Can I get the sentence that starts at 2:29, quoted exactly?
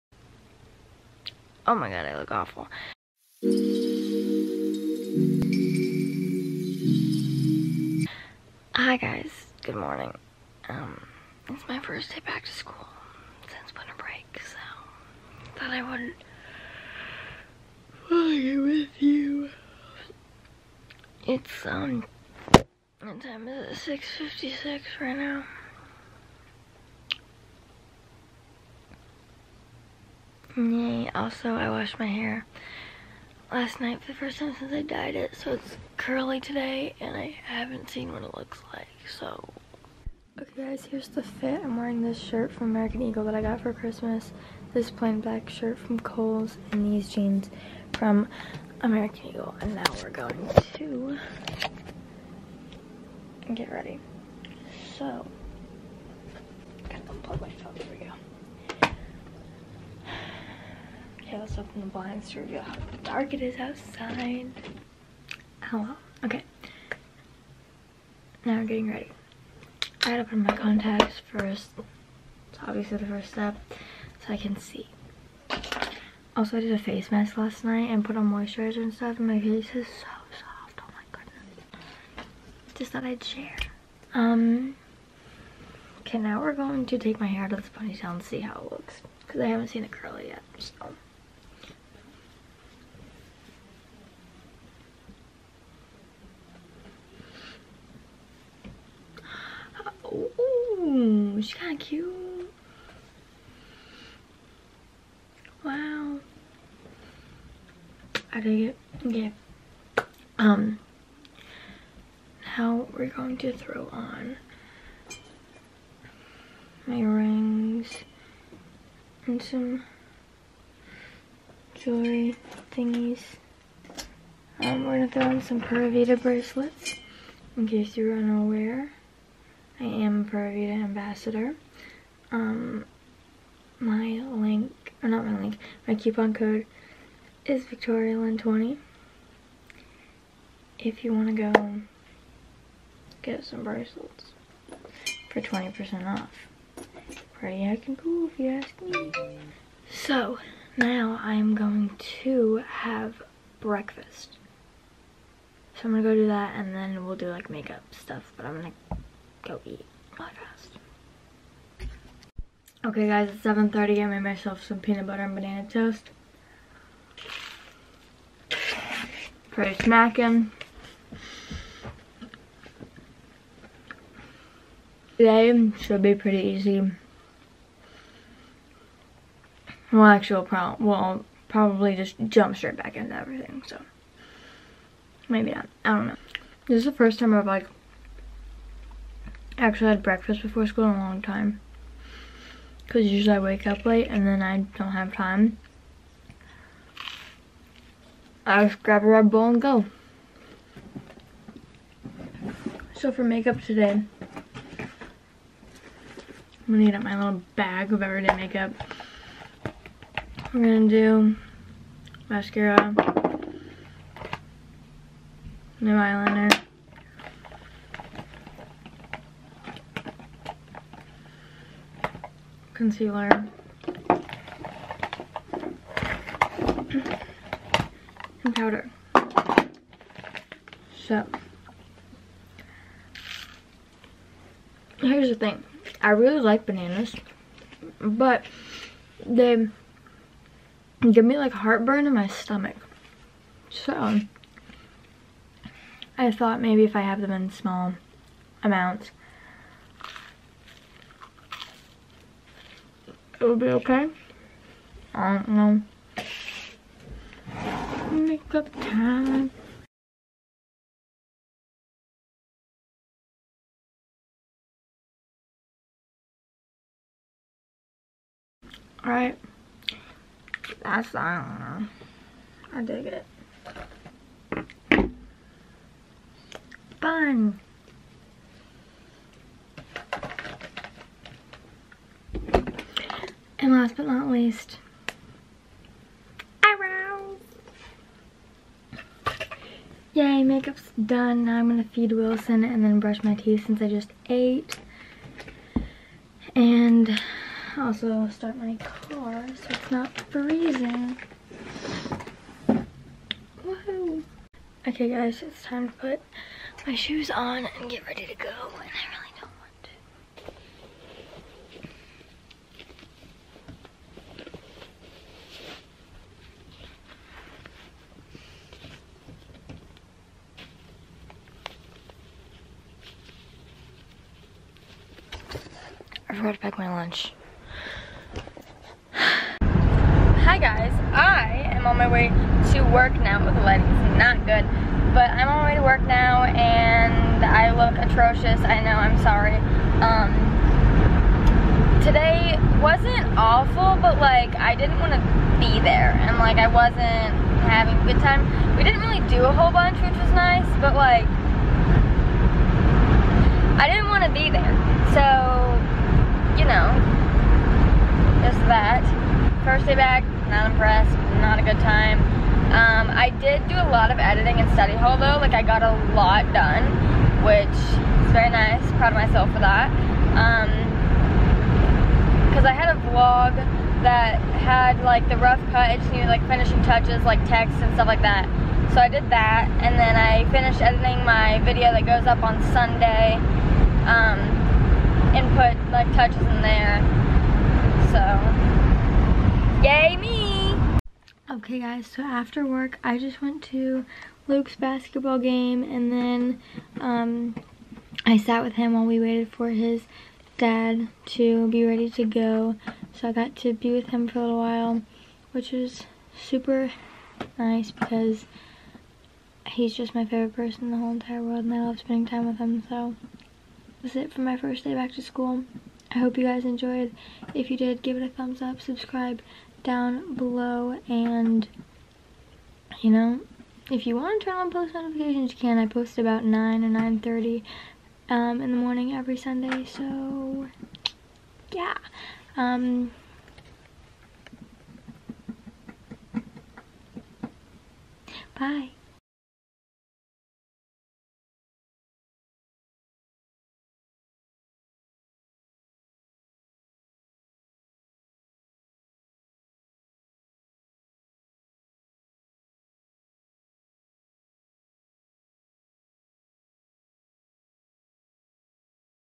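So, now I'm going to have breakfast.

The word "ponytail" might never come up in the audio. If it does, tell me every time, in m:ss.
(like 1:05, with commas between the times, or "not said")
1:27.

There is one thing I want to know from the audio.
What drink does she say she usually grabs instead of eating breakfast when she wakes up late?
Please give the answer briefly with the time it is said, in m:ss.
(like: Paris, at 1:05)
Red Bull, at 3:19.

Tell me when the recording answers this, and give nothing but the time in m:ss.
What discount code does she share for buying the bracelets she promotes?
2:17.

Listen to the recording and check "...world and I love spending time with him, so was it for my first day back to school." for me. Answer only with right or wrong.
right.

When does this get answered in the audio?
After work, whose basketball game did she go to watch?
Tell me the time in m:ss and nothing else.
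6:34.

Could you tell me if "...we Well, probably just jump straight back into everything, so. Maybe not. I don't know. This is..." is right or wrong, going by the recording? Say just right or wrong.
right.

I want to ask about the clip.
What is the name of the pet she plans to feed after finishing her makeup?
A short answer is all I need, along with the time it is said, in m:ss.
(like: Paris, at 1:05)
Wilson, at 4:52.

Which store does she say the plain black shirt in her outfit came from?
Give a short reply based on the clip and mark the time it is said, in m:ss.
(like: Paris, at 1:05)
Kohl's, at 0:46.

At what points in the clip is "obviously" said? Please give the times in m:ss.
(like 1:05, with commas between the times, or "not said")
1:12.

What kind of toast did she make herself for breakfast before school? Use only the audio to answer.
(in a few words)
Peanut butter and banana.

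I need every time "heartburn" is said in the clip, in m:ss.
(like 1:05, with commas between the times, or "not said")
4:01.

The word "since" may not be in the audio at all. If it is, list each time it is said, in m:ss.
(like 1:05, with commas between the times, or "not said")
0:13, 0:34, 4:53.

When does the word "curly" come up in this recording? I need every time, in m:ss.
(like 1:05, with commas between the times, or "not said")
0:35, 1:29.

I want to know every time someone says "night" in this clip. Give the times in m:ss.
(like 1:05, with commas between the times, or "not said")
0:33, 1:17.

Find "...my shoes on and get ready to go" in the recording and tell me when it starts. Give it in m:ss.
5:06.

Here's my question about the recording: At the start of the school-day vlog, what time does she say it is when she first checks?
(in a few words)
6:56.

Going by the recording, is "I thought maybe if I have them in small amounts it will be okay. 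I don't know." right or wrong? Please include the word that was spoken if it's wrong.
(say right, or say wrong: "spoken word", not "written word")
right.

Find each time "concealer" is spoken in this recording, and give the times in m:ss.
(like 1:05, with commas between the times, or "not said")
3:42.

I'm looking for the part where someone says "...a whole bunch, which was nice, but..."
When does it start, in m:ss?
5:49.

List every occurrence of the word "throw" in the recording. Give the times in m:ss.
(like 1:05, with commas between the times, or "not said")
1:53, 2:05.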